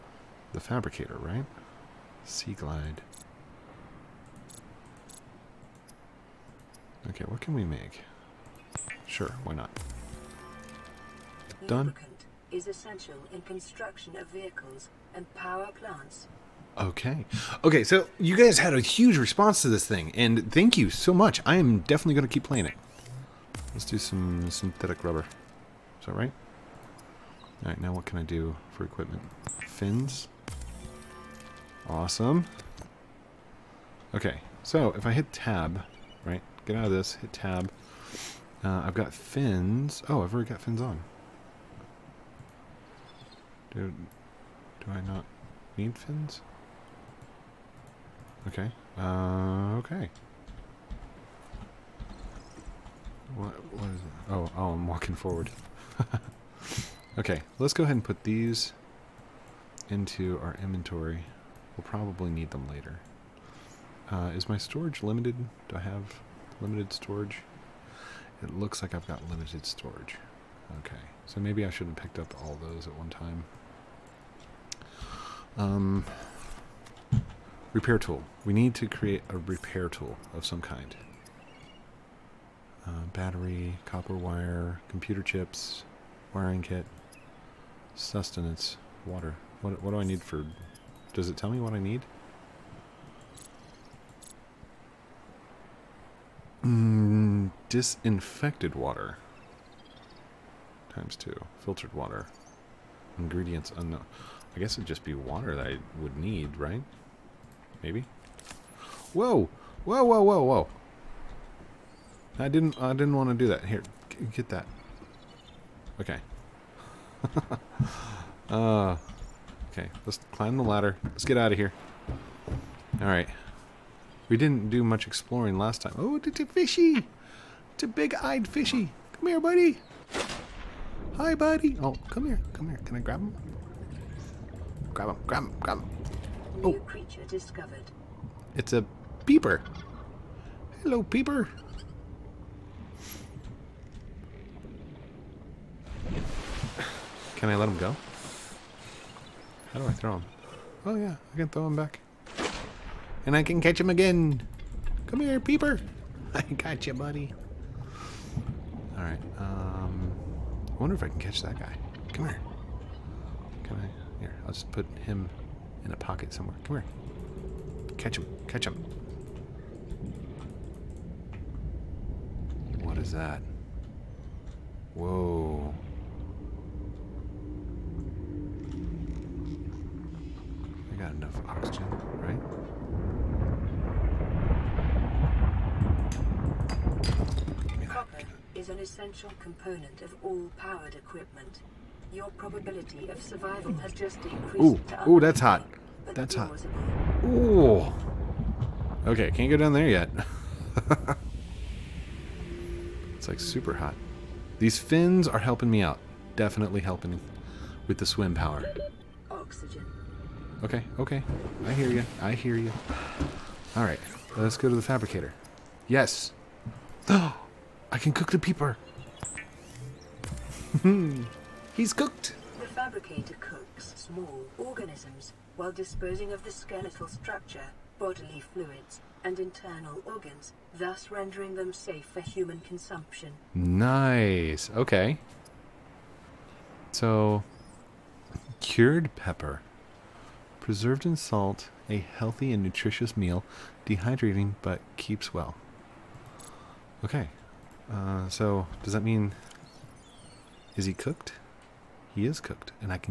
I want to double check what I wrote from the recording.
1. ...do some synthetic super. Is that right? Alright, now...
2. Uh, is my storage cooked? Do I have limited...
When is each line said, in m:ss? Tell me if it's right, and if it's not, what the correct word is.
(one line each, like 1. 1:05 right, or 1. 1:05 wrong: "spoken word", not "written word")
1. 0:23 wrong: "rubber", not "super"
2. 1:04 wrong: "limited", not "cooked".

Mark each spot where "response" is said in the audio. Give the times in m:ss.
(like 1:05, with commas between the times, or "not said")
0:19.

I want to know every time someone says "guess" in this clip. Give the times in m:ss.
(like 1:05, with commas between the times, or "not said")
1:44.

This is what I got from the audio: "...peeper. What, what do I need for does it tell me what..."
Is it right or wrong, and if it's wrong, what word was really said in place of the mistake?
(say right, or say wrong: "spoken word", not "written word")
wrong: "water", not "peeper".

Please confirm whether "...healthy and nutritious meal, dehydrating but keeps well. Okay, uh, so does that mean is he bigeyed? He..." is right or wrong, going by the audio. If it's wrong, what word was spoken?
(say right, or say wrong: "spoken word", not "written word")
wrong: "cooked", not "bigeyed".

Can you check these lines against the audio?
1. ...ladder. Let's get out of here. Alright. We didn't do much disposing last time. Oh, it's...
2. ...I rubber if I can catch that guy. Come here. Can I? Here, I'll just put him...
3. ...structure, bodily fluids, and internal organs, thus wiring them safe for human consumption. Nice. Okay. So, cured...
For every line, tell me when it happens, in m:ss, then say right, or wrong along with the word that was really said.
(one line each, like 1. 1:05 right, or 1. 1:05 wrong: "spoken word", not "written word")
1. 2:00 wrong: "exploring", not "disposing"
2. 2:40 wrong: "wonder", not "rubber"
3. 3:47 wrong: "rendering", not "wiring".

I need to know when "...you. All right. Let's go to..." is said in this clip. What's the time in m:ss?
3:32.